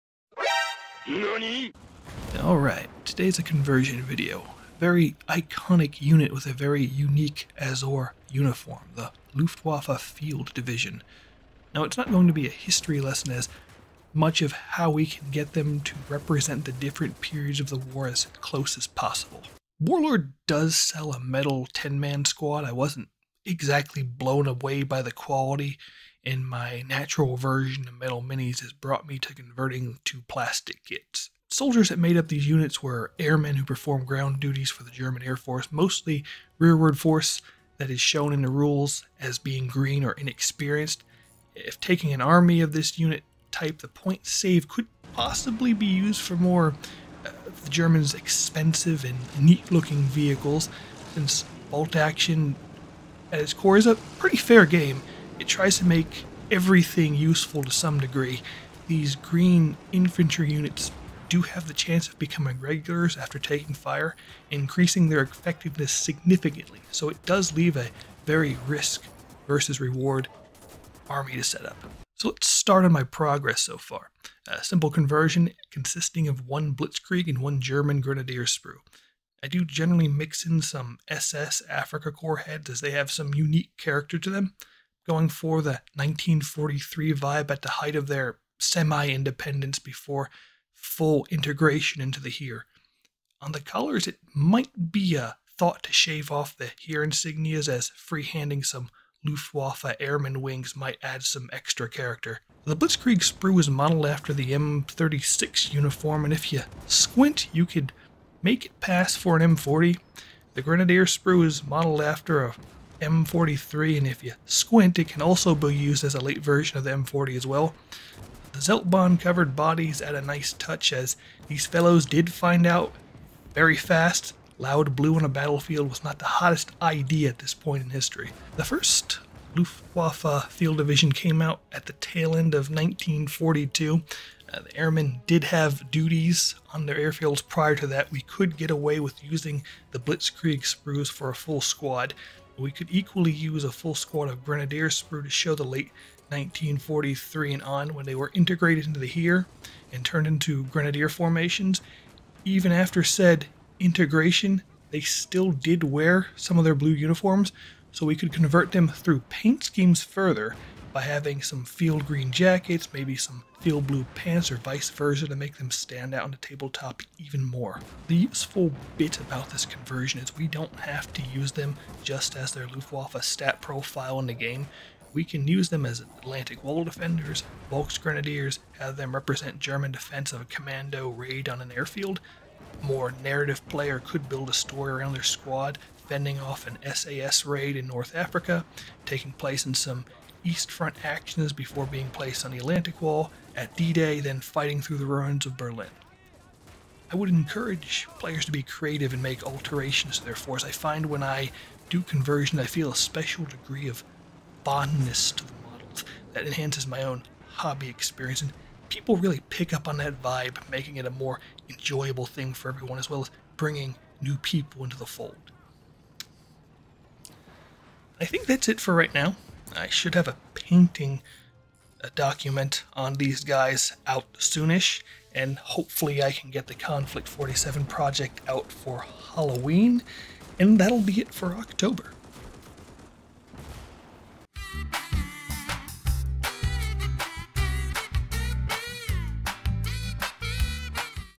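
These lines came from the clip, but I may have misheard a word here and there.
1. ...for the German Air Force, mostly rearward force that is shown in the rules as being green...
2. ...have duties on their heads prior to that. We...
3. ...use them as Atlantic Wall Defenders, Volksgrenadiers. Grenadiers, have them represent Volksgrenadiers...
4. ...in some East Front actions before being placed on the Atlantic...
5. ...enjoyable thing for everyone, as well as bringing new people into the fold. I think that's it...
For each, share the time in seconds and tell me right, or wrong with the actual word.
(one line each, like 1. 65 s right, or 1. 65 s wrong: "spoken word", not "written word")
1. 34 s right
2. 135 s wrong: "airfields", not "heads"
3. 175 s wrong: "German", not "Volksgrenadiers"
4. 189 s right
5. 211 s right.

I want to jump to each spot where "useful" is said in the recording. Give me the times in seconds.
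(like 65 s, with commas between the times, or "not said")
57 s, 168 s.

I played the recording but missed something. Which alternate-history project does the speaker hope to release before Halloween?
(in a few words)
Konflikt 47.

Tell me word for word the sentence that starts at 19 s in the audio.
Warlord does sell a metal 10 man squad.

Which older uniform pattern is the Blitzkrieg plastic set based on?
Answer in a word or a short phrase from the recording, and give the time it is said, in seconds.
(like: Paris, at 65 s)
M36, at 104 s.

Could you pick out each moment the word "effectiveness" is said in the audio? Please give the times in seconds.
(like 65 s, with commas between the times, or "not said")
65 s.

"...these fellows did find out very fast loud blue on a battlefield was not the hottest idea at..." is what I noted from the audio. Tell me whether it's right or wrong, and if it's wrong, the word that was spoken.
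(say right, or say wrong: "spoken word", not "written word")
right.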